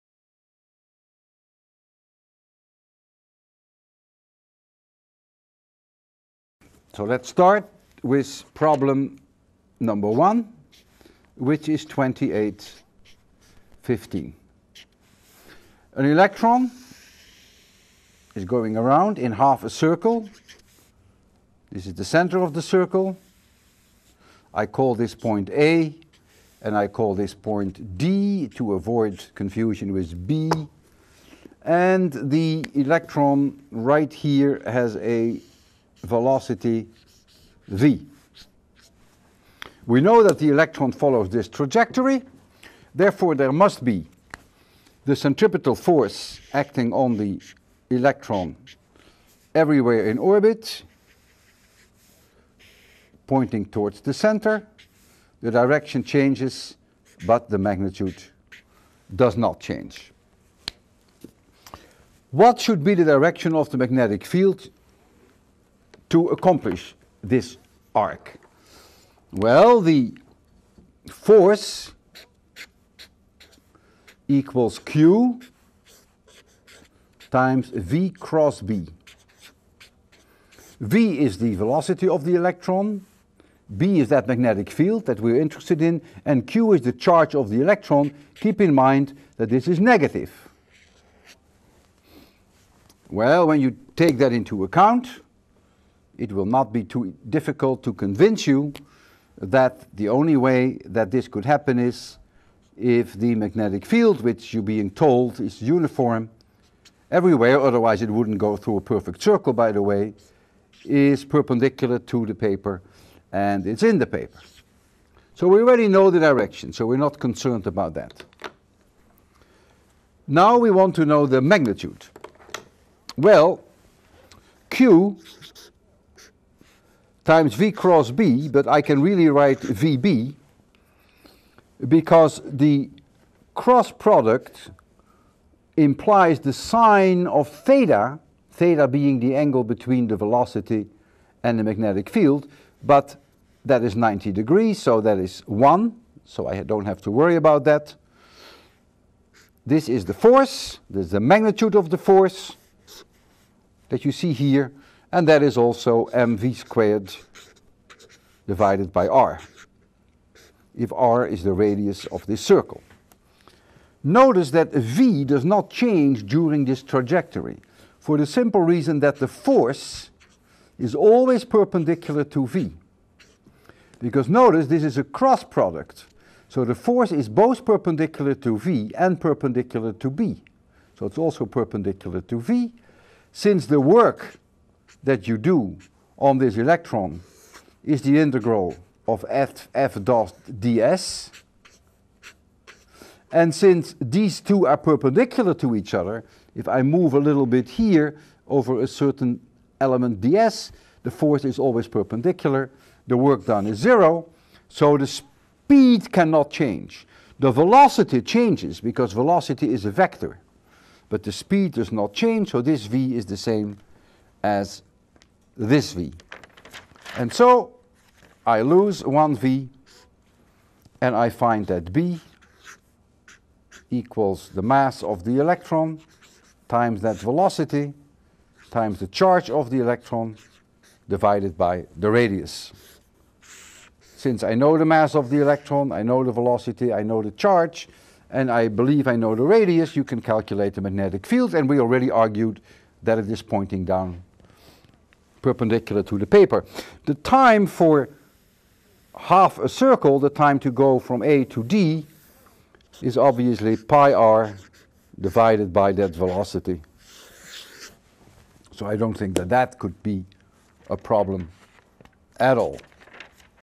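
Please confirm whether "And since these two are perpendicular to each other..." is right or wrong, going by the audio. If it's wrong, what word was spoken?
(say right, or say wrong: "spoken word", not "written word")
right.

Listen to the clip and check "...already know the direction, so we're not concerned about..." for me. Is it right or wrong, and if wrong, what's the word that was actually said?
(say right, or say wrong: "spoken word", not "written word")
right.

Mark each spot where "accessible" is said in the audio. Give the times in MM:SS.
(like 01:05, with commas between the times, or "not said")
not said.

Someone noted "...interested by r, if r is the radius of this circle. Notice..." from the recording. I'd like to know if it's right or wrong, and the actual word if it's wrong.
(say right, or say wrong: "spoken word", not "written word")
wrong: "divided", not "interested".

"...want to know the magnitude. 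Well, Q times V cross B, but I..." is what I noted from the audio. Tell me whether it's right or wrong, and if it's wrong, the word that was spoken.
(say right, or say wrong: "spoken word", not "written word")
right.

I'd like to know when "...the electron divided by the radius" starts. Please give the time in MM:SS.
03:49.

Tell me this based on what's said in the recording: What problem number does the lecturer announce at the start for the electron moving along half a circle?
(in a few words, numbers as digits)
2815.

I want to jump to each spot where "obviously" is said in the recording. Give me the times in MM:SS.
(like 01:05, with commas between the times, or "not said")
04:13.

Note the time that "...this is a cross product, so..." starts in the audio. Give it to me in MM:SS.
02:54.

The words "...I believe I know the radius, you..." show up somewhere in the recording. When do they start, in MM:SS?
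03:58.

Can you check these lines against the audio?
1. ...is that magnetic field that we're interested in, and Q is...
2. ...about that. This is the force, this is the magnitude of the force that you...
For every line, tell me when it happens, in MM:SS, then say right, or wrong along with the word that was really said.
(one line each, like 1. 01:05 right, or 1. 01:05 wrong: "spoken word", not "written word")
1. 01:24 right
2. 02:27 right.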